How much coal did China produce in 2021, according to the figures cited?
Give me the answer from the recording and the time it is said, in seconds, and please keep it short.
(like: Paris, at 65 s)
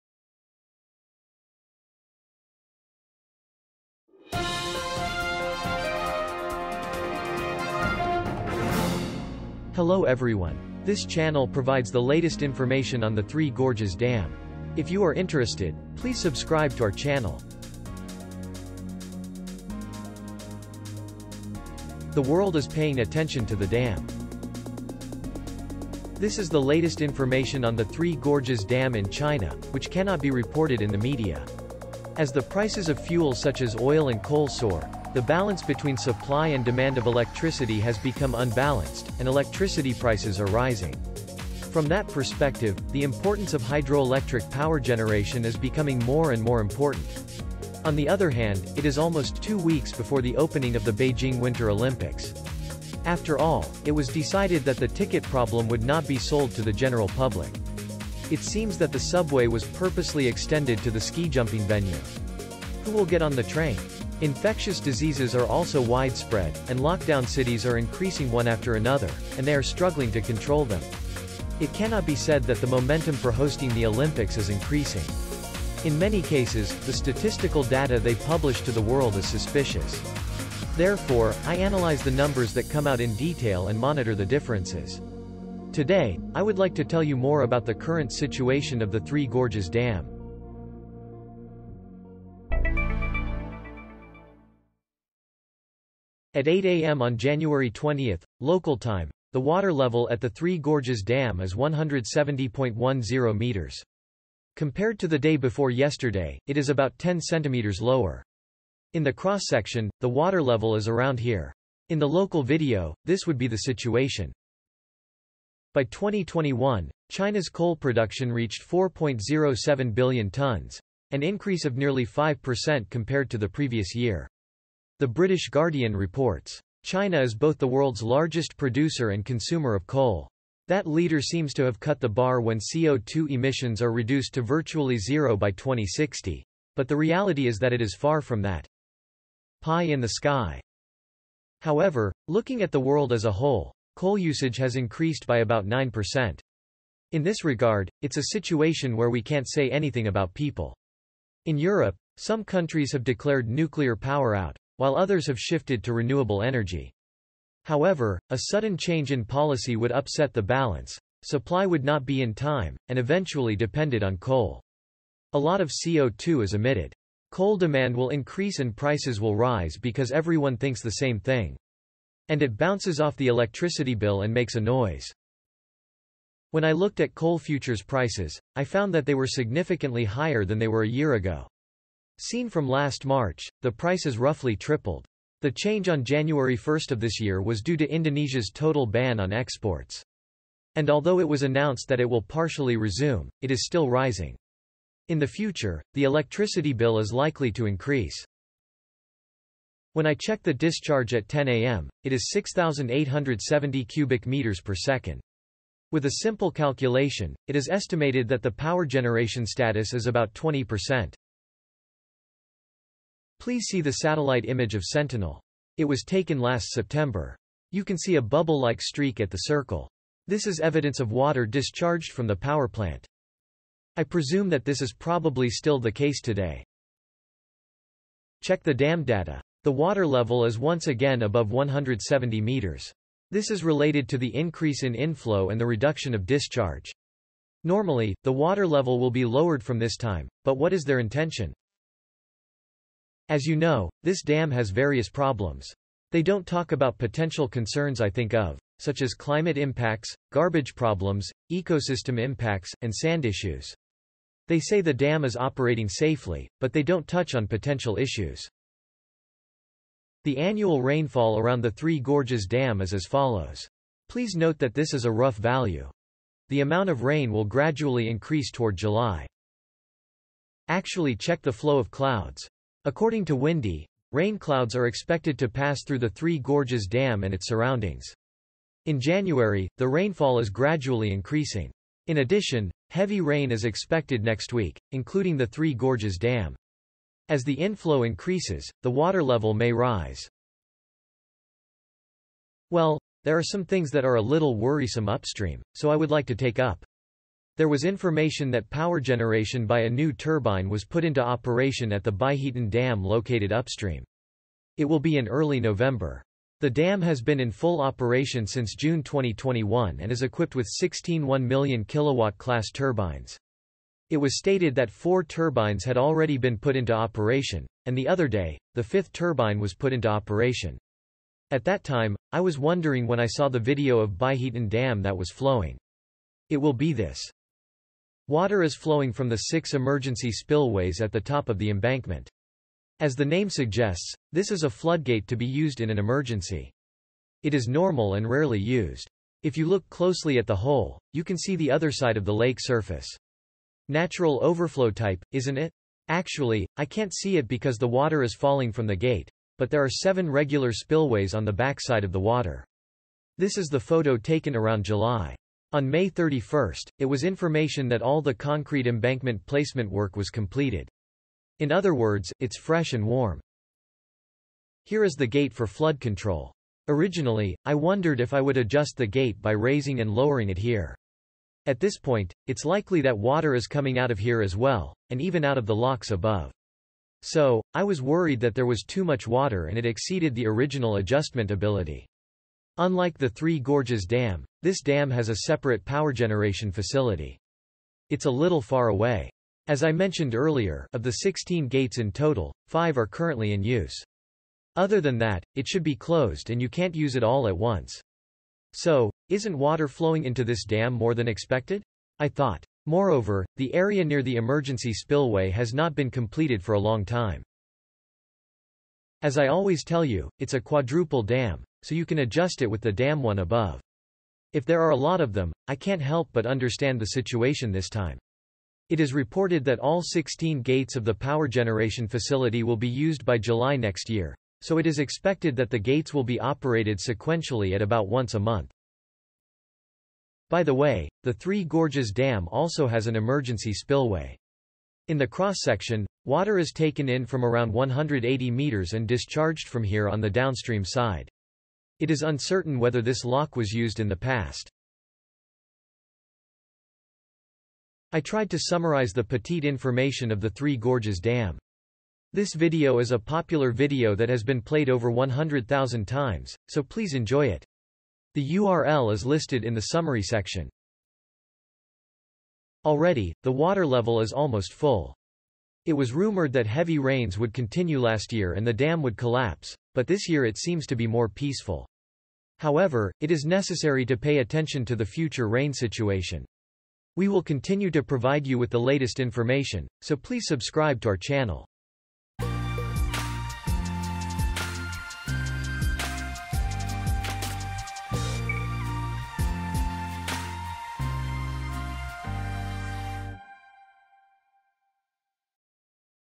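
4.07 billion tons, at 118 s.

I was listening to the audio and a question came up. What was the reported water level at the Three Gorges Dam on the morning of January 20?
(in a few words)
170.10 meters.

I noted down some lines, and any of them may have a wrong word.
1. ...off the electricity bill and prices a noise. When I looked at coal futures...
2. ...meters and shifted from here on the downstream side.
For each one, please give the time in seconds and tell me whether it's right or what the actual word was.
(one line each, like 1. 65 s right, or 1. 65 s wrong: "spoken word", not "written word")
1. 172 s wrong: "makes", not "prices"
2. 438 s wrong: "discharged", not "shifted".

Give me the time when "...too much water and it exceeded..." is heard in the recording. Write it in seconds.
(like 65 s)
378 s.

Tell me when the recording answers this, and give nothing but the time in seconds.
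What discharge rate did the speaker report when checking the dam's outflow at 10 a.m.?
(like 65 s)
202 s.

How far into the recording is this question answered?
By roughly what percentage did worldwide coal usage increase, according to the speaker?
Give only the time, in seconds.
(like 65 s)
145 s.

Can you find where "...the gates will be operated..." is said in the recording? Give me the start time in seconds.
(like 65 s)
425 s.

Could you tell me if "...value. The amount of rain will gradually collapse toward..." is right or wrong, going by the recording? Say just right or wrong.
wrong.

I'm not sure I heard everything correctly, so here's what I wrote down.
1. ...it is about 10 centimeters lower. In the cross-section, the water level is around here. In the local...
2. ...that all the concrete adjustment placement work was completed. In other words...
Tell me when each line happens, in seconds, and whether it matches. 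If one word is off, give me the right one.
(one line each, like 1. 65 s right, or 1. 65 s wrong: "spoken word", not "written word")
1. 106 s right
2. 357 s wrong: "embankment", not "adjustment".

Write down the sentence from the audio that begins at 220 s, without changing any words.
This is evidence of water discharged from the power plant.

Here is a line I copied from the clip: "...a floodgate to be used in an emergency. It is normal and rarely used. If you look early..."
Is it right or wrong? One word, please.
wrong.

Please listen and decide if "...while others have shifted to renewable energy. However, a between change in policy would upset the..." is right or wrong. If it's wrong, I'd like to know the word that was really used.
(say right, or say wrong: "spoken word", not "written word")
wrong: "sudden", not "between".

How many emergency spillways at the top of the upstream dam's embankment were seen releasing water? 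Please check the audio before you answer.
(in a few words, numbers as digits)
6.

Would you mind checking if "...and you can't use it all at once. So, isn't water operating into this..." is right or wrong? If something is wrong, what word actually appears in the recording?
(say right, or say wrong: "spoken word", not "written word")
wrong: "flowing", not "operating".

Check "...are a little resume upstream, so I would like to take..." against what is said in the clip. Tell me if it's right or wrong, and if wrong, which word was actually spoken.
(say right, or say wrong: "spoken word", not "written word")
wrong: "worrisome", not "resume".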